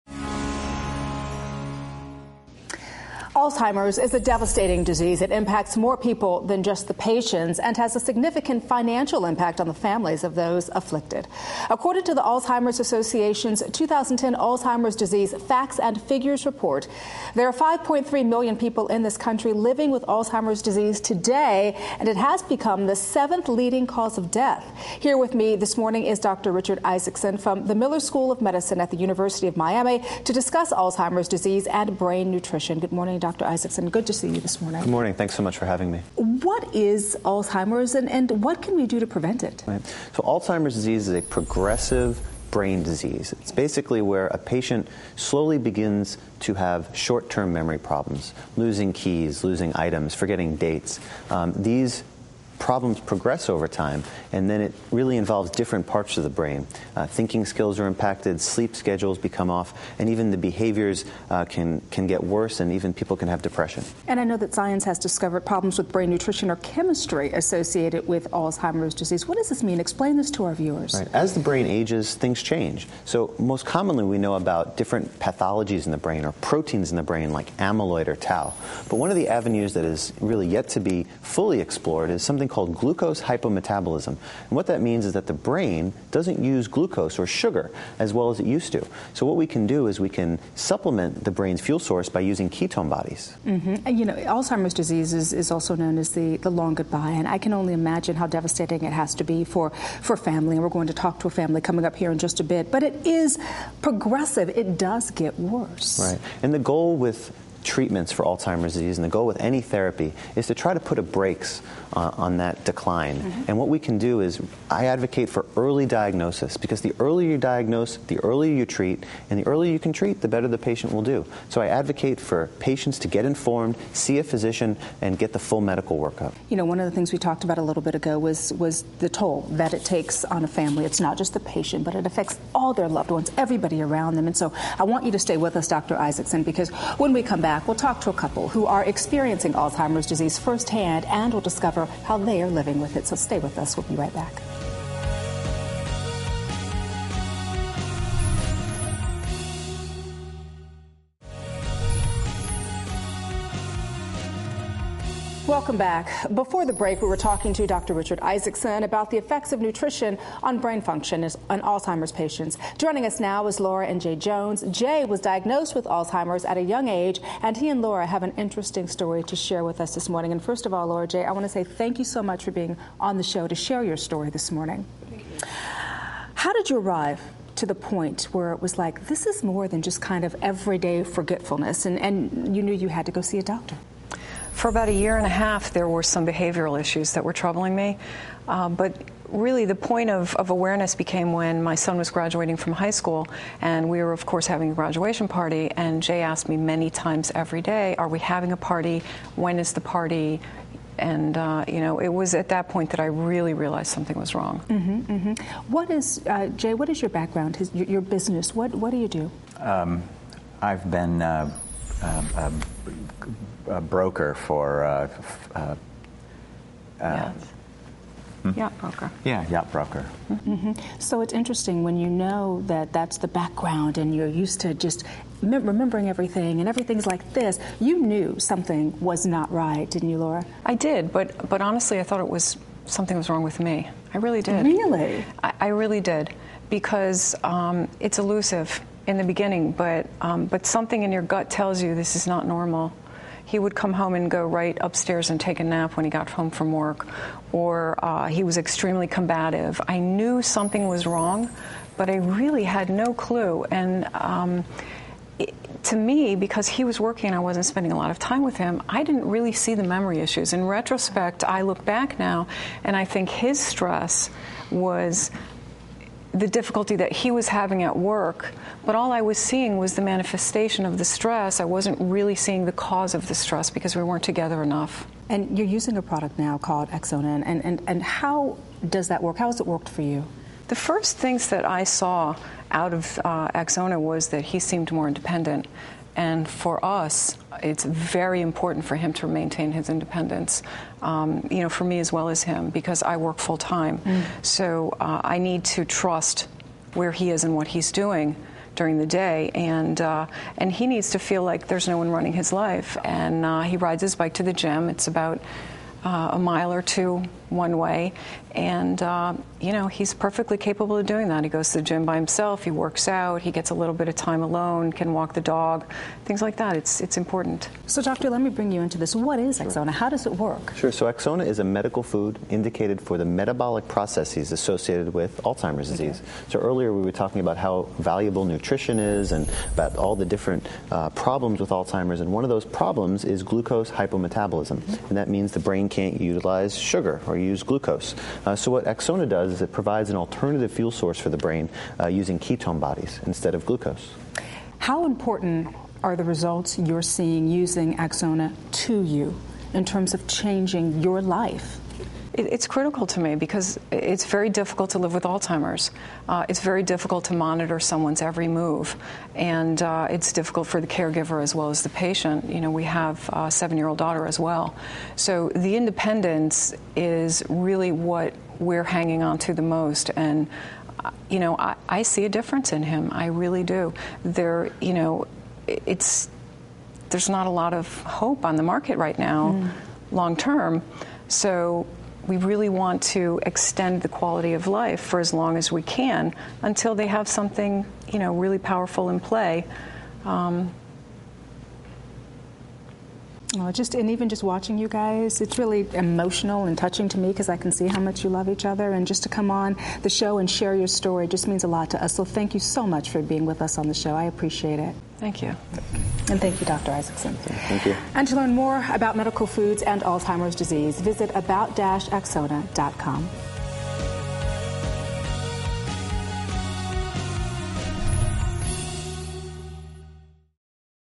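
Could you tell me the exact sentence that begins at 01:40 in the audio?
And we're going to talk to a family coming up here in just a bit, but it is progressive.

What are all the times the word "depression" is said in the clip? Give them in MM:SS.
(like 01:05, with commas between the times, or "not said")
01:03.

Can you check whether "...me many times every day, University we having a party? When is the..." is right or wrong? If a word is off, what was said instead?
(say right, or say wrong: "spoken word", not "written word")
wrong: "Are", not "University".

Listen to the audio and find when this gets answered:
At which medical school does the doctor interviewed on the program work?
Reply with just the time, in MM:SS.
00:27.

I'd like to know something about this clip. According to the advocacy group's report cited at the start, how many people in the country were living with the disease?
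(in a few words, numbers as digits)
5.3 million.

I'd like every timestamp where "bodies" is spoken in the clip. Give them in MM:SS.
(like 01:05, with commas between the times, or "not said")
01:32, 05:42.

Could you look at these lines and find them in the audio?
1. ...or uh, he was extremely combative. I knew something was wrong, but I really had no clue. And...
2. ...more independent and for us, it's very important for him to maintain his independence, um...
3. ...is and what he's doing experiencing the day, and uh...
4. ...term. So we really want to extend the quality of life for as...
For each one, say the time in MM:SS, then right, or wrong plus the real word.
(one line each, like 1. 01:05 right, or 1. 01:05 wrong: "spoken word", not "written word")
1. 04:07 right
2. 04:44 right
3. 04:57 wrong: "during", not "experiencing"
4. 06:20 right.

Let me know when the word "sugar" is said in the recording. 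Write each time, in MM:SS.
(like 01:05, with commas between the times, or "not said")
01:27, 05:36.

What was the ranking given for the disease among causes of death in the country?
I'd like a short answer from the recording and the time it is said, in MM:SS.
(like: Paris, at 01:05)
seventh, at 00:22.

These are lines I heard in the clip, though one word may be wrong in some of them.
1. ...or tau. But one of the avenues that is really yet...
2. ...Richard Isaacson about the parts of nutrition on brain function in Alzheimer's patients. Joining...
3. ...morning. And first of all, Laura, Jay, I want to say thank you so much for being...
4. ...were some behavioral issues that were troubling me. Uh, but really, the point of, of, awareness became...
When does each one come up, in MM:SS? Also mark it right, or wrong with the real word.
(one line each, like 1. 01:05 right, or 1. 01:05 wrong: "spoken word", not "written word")
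1. 01:18 right
2. 02:37 wrong: "effects", not "parts"
3. 02:50 right
4. 03:05 right.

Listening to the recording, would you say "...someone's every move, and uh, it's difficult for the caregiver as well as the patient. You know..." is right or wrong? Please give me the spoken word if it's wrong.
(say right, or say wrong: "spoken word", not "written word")
right.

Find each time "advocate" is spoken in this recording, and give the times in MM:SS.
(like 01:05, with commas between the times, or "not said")
01:54, 02:01.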